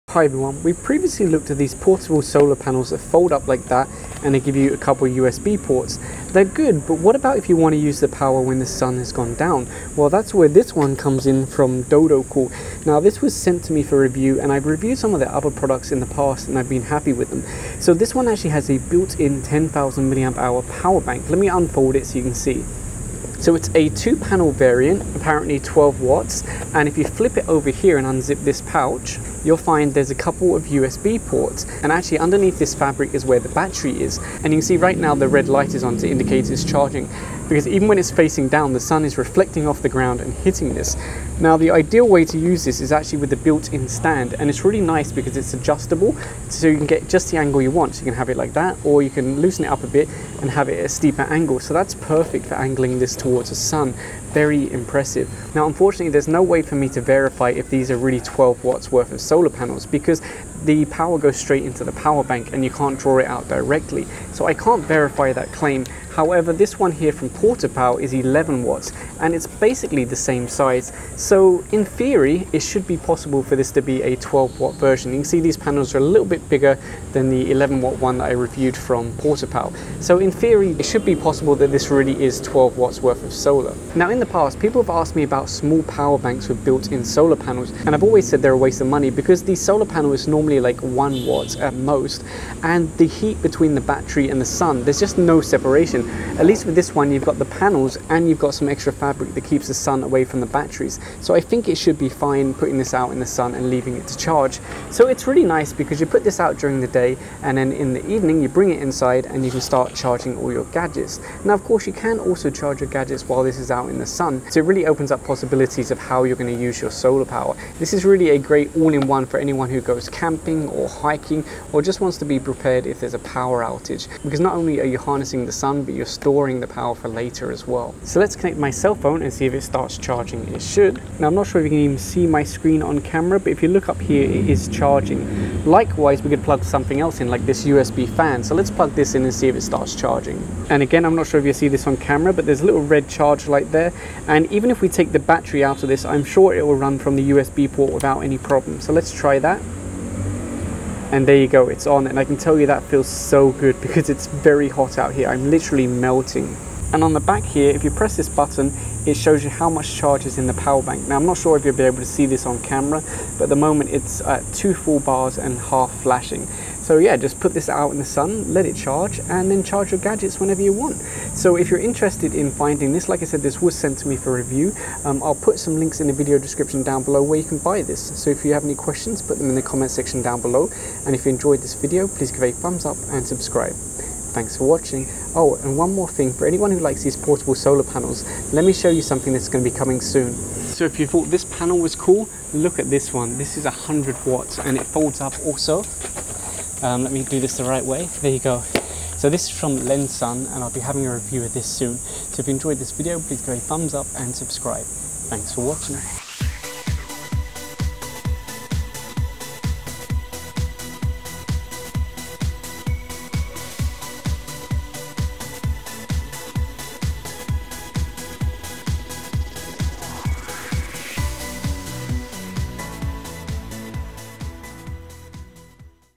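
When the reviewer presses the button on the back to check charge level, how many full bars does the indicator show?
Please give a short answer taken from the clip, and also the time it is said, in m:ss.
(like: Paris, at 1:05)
2, at 2:44.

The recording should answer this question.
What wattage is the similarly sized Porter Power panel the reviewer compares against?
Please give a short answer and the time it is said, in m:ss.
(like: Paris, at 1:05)
11 watts, at 1:08.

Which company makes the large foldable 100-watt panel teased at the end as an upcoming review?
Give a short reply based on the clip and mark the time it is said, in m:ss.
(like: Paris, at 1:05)
Lensun, at 3:19.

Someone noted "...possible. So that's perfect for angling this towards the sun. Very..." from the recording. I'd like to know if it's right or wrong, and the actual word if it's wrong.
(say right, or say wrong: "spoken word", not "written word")
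wrong: "angle", not "possible".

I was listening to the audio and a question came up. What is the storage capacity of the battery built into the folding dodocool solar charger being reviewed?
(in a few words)
10,000 mAh.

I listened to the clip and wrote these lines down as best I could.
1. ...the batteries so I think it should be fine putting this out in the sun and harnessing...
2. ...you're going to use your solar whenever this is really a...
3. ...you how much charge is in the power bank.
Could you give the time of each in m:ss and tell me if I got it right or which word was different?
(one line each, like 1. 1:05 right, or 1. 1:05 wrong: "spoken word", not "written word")
1. 1:40 wrong: "leaving", not "harnessing"
2. 1:56 wrong: "power", not "whenever"
3. 2:39 right.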